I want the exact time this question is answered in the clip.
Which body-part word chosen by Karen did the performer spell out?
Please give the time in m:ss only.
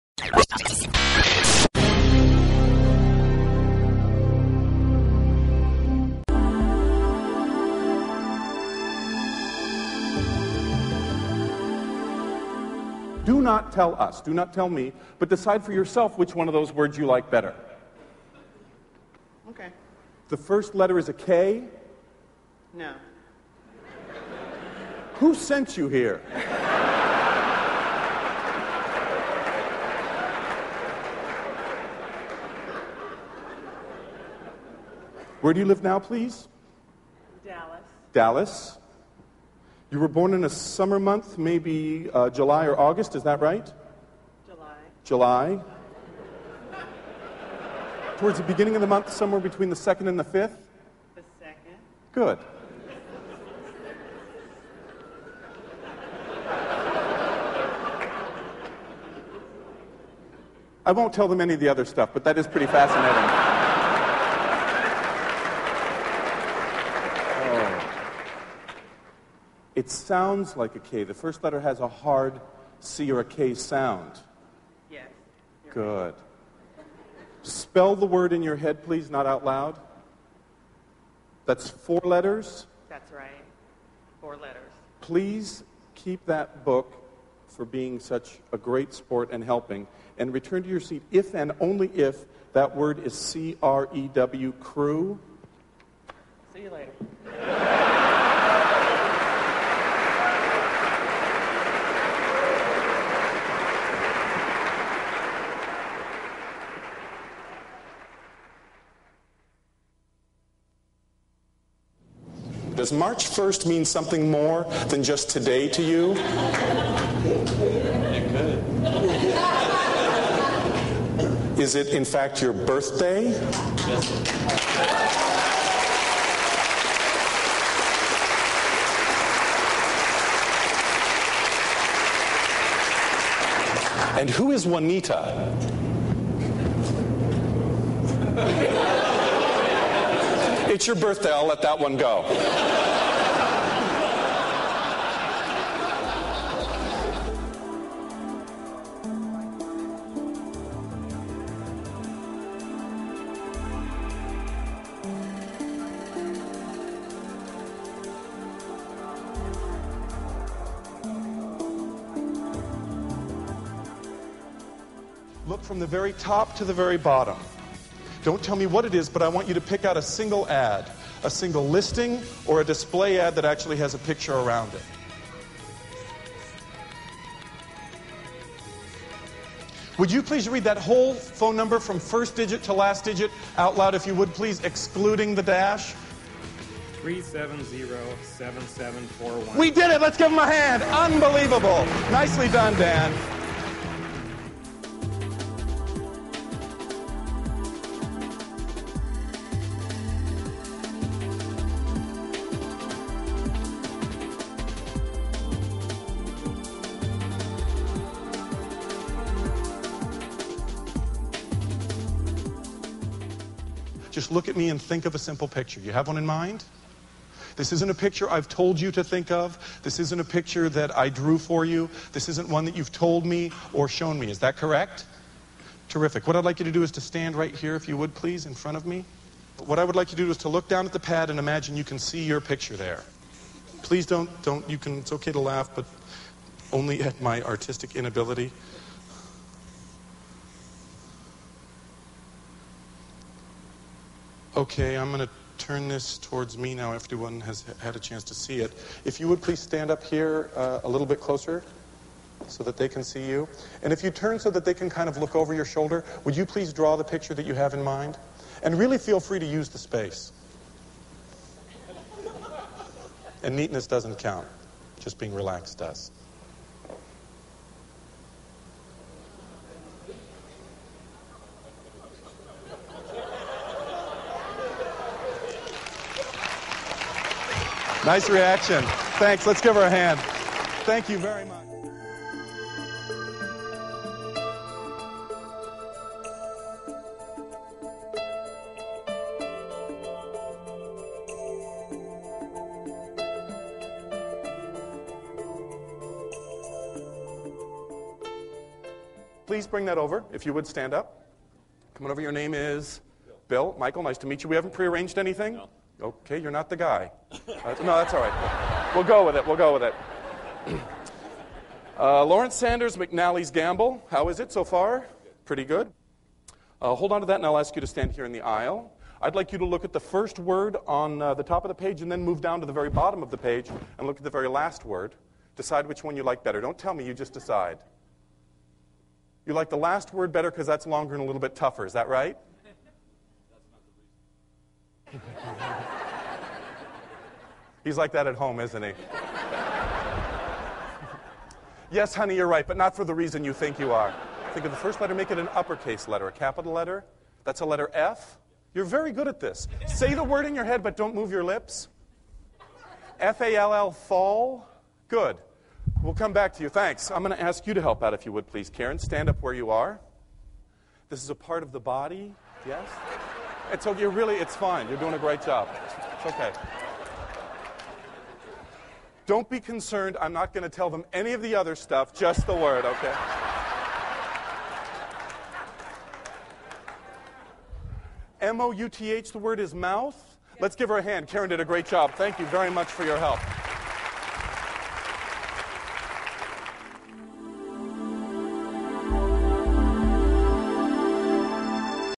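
6:18.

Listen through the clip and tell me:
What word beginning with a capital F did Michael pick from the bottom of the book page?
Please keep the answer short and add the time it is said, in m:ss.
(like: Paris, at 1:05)
fall, at 5:53.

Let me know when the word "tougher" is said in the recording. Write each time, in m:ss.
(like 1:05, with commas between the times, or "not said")
5:31.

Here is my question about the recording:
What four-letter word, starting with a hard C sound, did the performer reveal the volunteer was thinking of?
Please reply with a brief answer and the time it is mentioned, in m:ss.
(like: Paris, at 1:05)
crew, at 1:33.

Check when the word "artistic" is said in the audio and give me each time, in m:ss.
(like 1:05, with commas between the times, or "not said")
3:57.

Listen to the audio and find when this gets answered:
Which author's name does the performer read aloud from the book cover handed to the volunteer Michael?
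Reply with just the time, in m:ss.
5:12.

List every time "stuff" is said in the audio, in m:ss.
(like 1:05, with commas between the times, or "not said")
1:01, 6:11.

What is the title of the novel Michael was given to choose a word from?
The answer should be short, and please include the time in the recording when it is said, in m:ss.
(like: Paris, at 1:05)
McNally's Gamble, at 5:12.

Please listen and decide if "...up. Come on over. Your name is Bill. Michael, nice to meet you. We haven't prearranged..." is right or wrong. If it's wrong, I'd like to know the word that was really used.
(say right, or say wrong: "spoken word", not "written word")
right.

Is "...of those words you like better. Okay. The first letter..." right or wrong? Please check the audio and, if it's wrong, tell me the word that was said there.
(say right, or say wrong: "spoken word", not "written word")
right.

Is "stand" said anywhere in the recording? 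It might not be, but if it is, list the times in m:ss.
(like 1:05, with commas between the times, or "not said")
3:47, 4:09, 5:00, 5:17, 5:58.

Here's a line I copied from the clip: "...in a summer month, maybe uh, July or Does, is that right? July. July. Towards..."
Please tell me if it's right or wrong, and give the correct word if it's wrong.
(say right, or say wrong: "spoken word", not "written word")
wrong: "August", not "Does".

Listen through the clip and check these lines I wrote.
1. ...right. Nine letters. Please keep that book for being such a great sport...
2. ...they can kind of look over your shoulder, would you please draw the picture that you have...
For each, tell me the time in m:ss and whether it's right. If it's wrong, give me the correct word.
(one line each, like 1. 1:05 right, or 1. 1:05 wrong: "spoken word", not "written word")
1. 1:23 wrong: "Four", not "Nine"
2. 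4:14 right.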